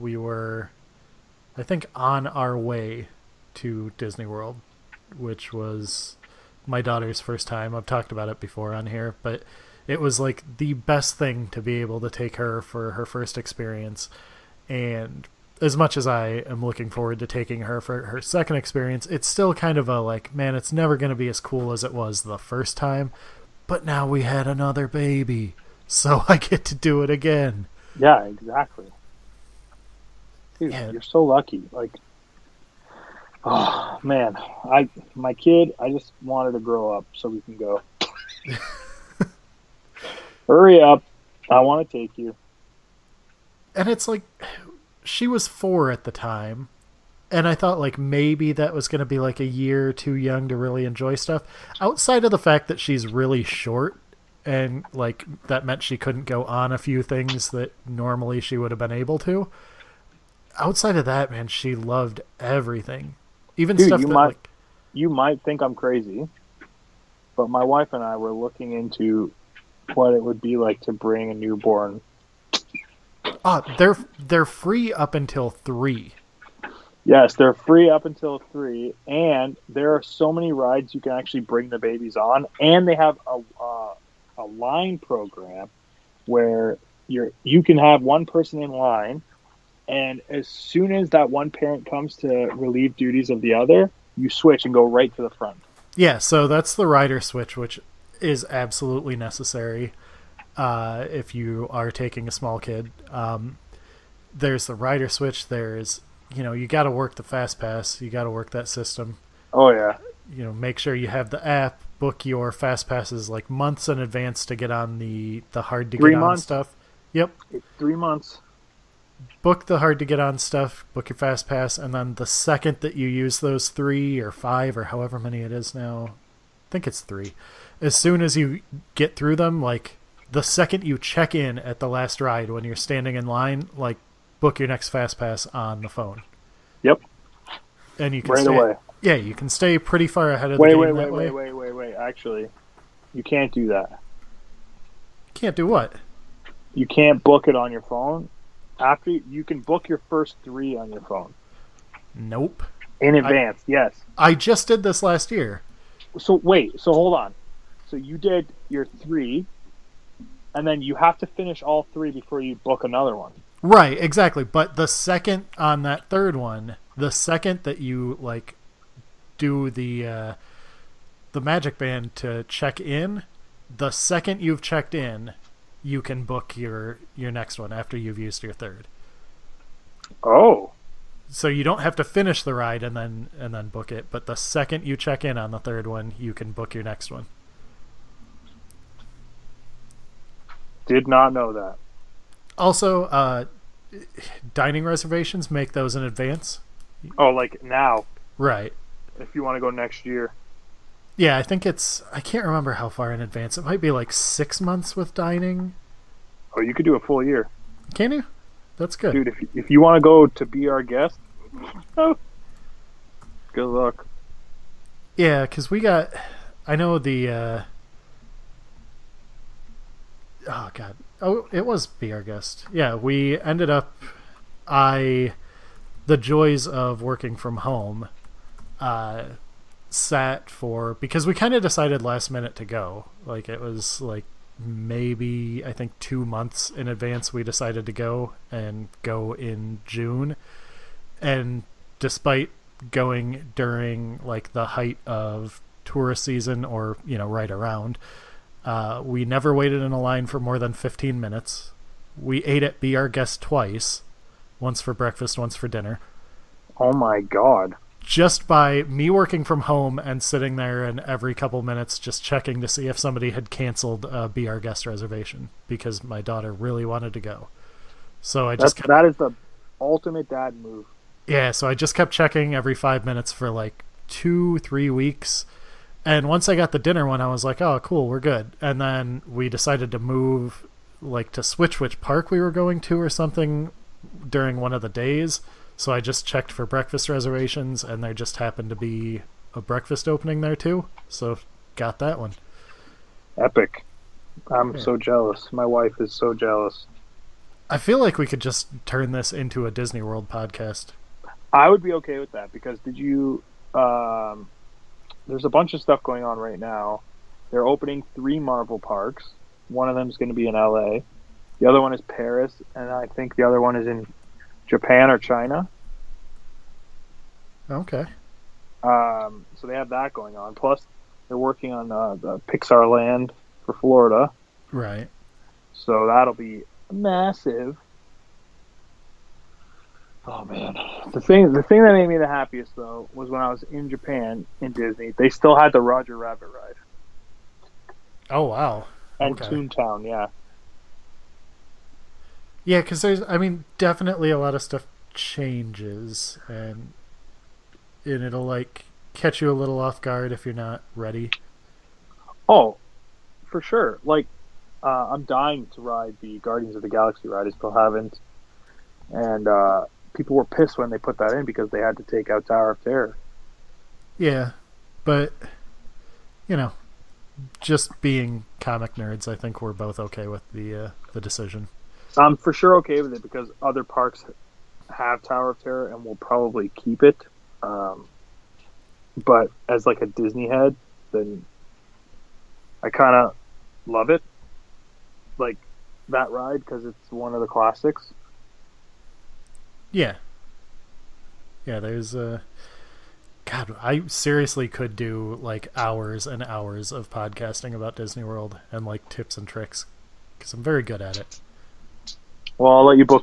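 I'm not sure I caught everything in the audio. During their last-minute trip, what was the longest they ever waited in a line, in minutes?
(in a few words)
15.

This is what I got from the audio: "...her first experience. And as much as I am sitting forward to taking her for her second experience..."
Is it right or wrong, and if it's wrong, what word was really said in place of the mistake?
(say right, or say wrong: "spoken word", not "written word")
wrong: "looking", not "sitting".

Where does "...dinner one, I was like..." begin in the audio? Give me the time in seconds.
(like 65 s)
276 s.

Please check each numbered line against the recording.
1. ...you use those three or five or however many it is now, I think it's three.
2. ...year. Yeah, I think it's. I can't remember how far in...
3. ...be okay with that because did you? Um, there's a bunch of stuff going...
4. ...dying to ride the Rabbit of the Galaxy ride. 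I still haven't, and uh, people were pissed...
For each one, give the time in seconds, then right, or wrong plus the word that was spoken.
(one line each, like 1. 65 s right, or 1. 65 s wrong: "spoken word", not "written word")
1. 122 s right
2. 200 s right
3. 301 s right
4. 355 s wrong: "Guardians", not "Rabbit".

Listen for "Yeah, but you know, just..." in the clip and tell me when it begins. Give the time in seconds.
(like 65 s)
364 s.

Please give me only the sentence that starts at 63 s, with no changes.
Even Dude, stuff you that, might like...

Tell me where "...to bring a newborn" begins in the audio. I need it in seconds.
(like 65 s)
70 s.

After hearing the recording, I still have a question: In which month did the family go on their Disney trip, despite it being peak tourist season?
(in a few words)
June.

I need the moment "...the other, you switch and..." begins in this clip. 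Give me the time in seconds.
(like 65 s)
93 s.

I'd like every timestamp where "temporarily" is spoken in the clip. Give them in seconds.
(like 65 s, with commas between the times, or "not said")
not said.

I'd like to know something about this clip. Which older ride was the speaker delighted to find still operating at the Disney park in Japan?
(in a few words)
Roger Rabbit ride.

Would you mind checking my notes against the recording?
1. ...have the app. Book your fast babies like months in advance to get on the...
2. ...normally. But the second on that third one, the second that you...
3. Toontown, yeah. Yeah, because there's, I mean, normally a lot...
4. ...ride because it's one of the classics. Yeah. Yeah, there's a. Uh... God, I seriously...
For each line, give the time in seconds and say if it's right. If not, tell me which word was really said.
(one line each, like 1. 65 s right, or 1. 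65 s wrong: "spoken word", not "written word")
1. 111 s wrong: "passes", not "babies"
2. 163 s wrong: "exactly", not "normally"
3. 339 s wrong: "definitely", not "normally"
4. 386 s right.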